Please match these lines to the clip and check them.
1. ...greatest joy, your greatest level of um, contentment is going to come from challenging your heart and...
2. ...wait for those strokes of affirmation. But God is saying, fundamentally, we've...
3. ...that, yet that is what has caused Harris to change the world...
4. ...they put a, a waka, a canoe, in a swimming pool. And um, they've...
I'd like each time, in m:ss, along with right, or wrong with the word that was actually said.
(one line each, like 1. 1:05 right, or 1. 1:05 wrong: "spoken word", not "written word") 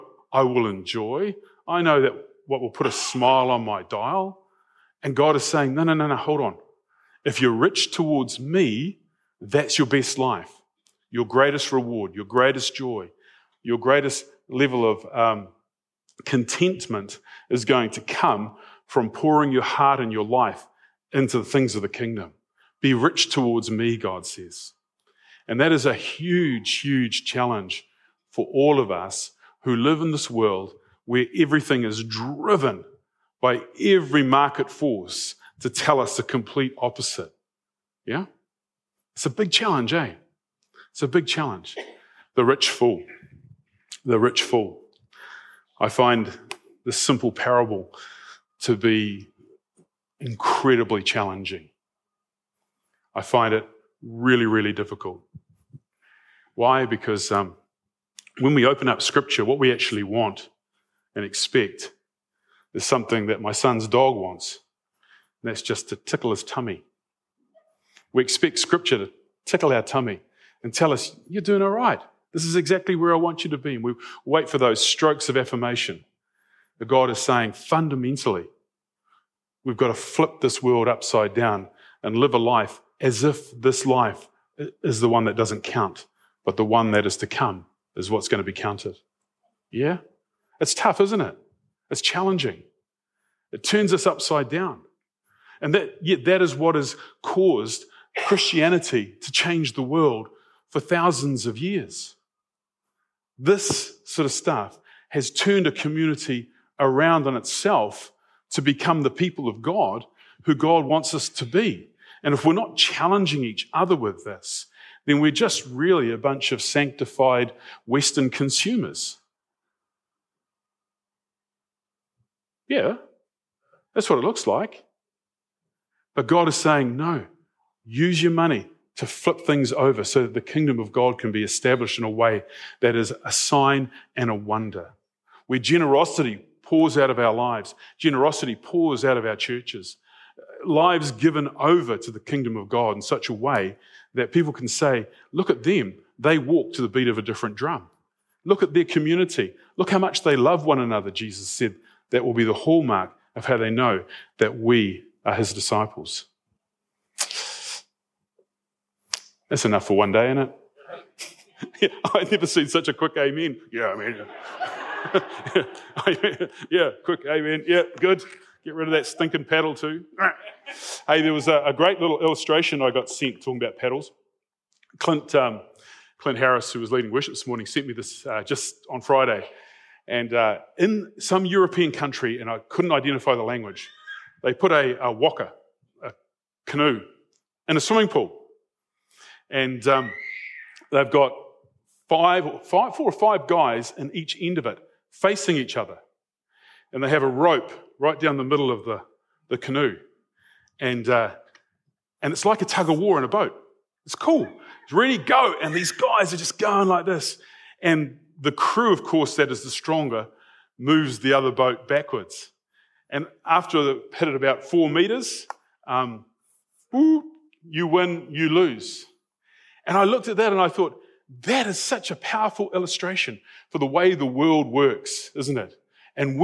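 1. 0:12 wrong: "pouring", not "challenging"
2. 1:14 right
3. 1:35 wrong: "Christianity", not "Harris"
4. 3:04 right.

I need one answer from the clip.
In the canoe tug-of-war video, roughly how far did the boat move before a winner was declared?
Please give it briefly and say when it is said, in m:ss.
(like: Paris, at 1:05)
4 meters, at 3:34.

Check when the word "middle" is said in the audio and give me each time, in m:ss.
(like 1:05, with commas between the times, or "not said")
3:18.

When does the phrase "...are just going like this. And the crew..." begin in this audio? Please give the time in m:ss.
3:26.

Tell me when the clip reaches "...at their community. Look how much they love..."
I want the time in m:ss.
2:28.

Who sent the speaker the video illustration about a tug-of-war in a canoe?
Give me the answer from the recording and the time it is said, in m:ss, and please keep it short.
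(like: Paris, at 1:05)
Clint Harris, at 2:56.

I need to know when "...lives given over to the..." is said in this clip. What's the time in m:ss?
2:20.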